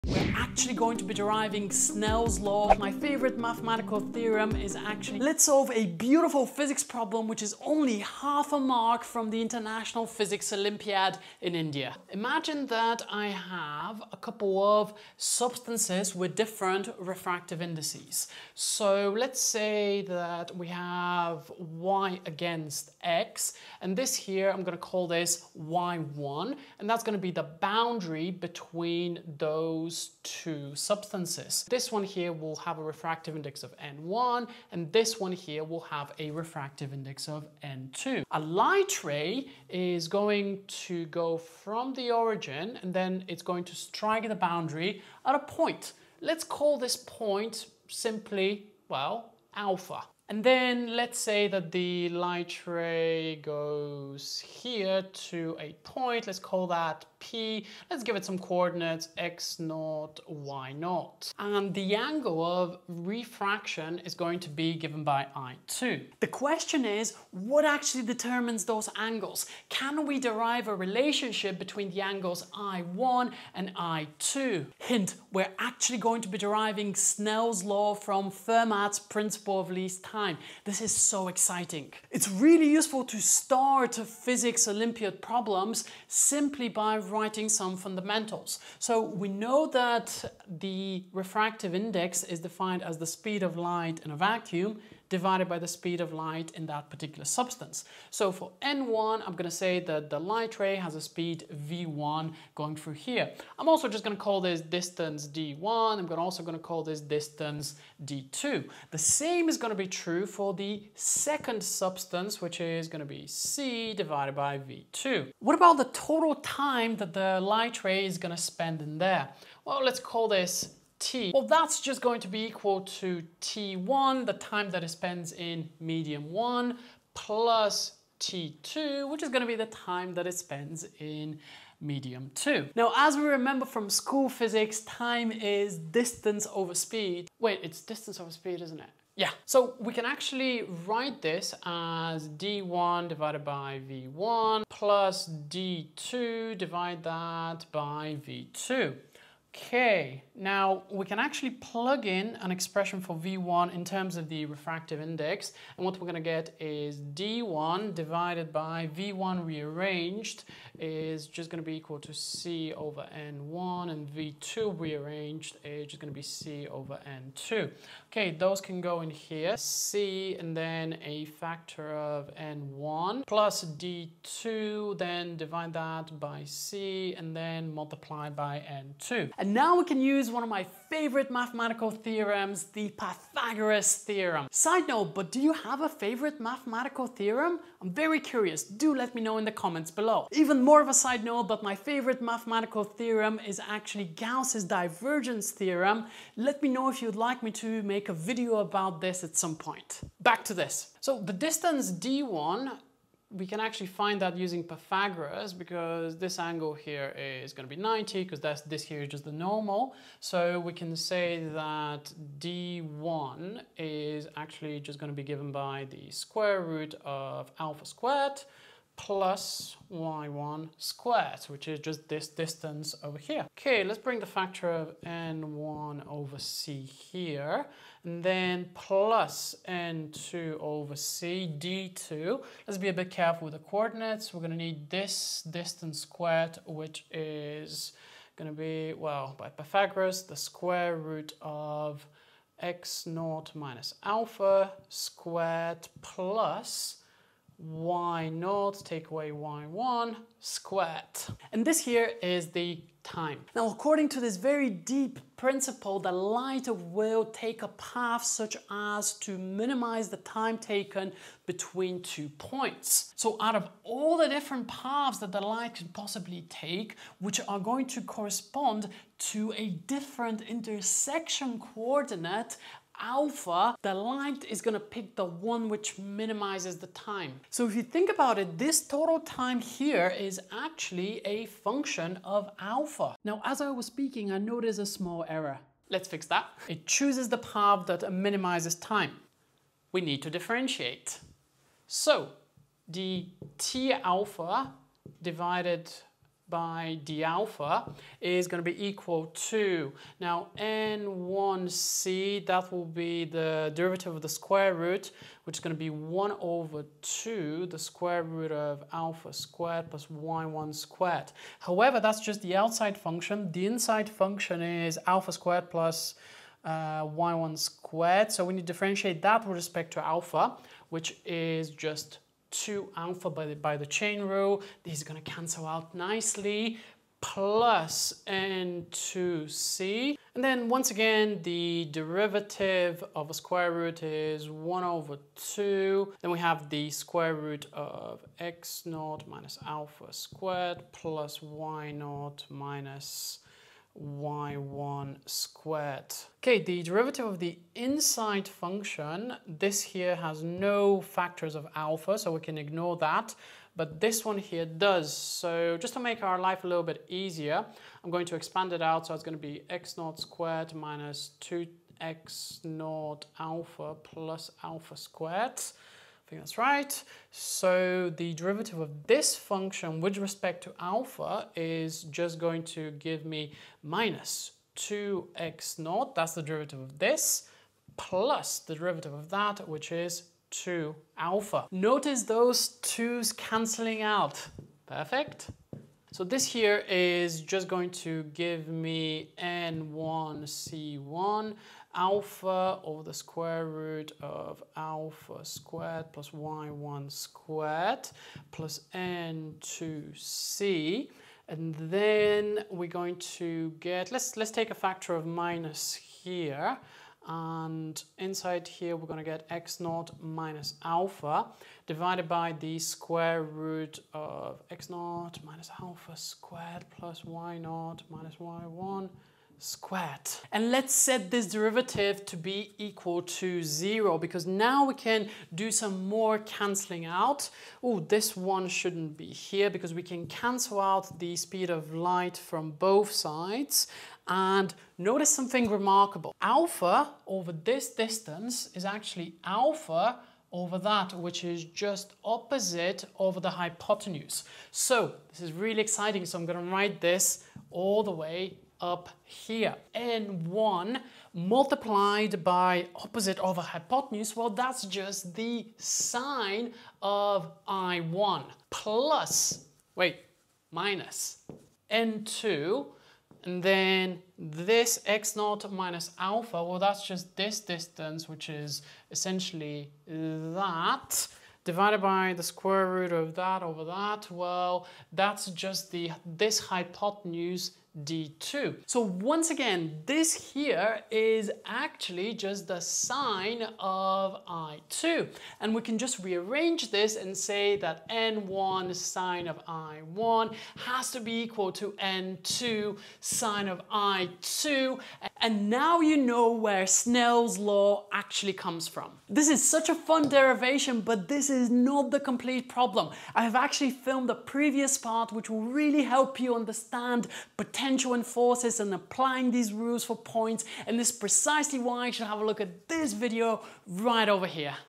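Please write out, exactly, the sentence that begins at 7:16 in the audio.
Alpha over this distance is actually alpha over that, which is just opposite over the hypotenuse.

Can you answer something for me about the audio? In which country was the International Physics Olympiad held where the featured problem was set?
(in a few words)
India.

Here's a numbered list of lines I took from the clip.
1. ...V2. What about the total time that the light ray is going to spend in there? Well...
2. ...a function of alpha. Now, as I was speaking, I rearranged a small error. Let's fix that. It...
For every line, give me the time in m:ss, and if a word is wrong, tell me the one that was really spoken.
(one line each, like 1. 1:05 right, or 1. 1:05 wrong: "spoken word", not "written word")
1. 1:54 right
2. 4:41 wrong: "noticed", not "rearranged".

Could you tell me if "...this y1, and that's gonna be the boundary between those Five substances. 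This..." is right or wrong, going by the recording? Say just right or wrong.
wrong.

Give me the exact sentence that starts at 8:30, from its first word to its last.
And this is precisely why you should have a look at this video right over here.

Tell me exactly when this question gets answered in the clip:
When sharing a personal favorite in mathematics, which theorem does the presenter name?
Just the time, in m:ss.
3:14.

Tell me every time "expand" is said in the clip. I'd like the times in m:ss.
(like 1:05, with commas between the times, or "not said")
5:58.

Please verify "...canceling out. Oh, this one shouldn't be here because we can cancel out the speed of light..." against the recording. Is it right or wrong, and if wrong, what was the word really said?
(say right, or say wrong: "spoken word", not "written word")
right.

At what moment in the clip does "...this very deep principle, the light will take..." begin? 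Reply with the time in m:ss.
4:14.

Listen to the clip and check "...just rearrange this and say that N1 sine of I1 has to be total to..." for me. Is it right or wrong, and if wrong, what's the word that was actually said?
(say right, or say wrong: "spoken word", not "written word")
wrong: "equal", not "total".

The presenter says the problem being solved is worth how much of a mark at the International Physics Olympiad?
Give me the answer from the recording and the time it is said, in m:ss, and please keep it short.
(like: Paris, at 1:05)
half a mark, at 0:07.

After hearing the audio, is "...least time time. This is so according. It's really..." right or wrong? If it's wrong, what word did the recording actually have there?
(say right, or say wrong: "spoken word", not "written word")
wrong: "exciting", not "according".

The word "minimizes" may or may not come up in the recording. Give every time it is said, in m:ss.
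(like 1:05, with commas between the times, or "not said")
4:19, 4:35, 4:48.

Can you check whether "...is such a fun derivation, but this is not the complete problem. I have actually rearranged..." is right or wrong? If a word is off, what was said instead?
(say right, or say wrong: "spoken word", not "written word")
wrong: "filmed", not "rearranged".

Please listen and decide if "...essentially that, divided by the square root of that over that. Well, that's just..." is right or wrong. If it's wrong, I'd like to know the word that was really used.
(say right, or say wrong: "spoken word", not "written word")
right.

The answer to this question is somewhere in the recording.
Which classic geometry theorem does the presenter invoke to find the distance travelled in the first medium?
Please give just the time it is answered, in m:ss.
3:02.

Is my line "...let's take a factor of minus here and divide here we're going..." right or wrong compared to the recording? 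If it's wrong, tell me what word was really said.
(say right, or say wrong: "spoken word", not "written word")
wrong: "inside", not "divide".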